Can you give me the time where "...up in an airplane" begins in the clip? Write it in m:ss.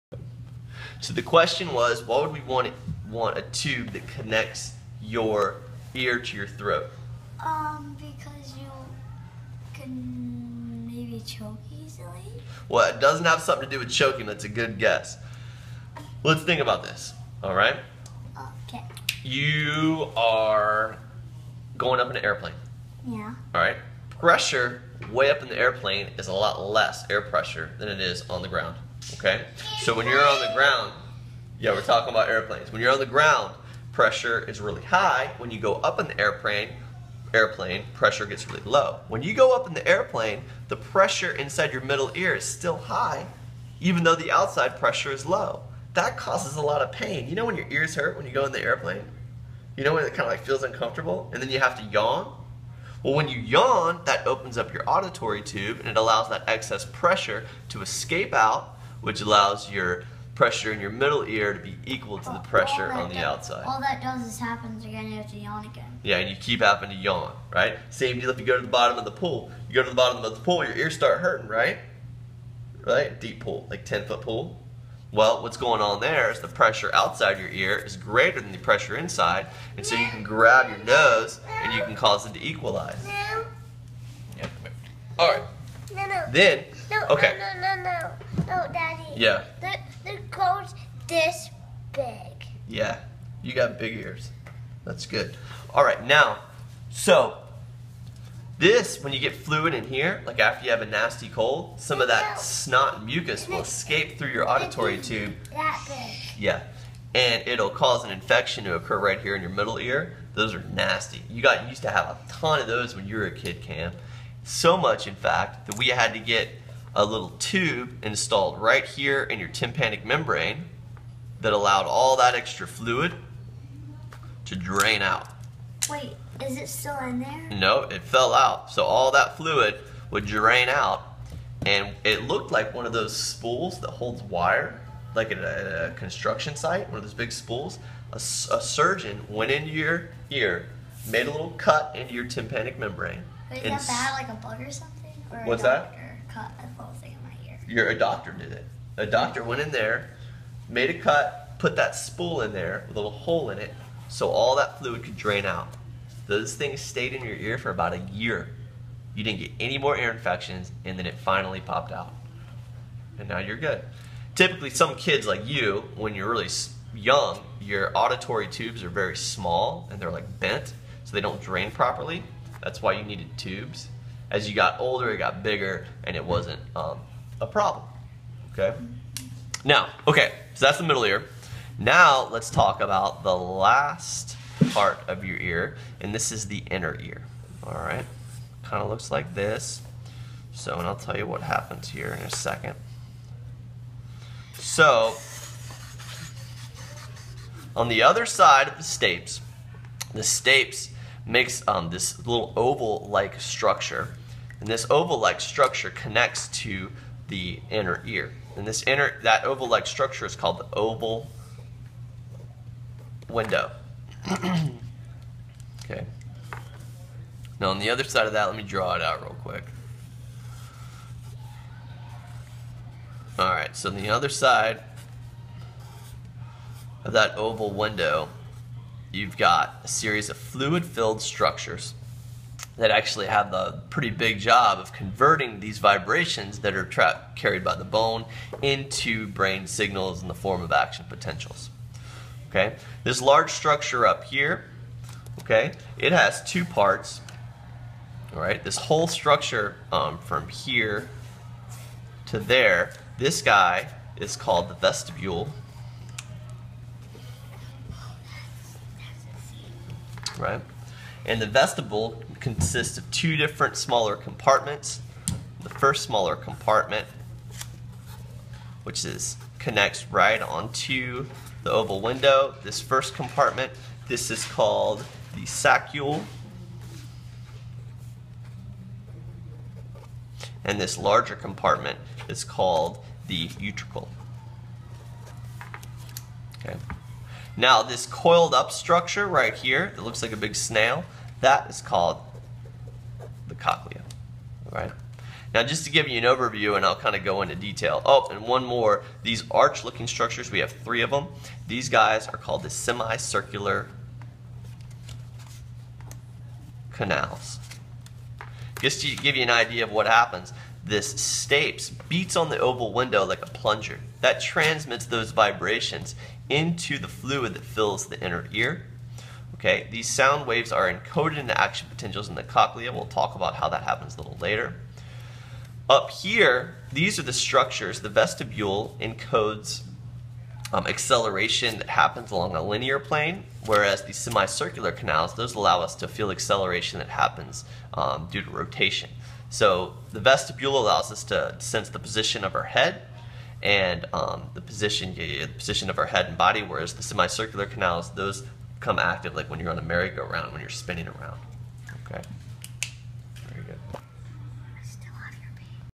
0:21.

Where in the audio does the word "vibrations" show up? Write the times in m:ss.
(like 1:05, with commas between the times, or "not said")
3:55, 5:15.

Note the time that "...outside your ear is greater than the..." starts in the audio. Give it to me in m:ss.
1:16.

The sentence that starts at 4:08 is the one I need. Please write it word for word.
All right, this whole structure um, from here to there, this guy is called the vestibule.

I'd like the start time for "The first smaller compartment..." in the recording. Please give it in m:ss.
4:25.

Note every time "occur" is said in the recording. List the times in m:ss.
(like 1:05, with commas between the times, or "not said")
1:48.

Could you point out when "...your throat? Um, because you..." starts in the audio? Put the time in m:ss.
0:06.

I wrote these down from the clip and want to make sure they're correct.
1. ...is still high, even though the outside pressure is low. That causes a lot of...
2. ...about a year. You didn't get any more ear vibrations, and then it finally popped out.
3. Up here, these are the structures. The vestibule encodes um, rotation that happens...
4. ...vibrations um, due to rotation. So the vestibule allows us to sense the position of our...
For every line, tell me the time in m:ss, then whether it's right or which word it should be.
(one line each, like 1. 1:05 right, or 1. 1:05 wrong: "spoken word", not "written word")
1. 0:42 right
2. 2:37 wrong: "infections", not "vibrations"
3. 5:25 wrong: "acceleration", not "rotation"
4. 5:37 wrong: "happens", not "vibrations".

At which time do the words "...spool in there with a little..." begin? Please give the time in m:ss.
2:31.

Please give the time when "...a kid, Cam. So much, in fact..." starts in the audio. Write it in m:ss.
1:53.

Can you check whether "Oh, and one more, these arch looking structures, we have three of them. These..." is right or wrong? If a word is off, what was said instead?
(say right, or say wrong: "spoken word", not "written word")
right.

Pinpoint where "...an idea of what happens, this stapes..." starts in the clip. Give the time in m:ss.
5:09.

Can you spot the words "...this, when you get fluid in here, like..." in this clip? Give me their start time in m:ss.
1:38.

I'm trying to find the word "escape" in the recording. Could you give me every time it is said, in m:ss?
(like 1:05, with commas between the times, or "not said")
0:57, 1:43.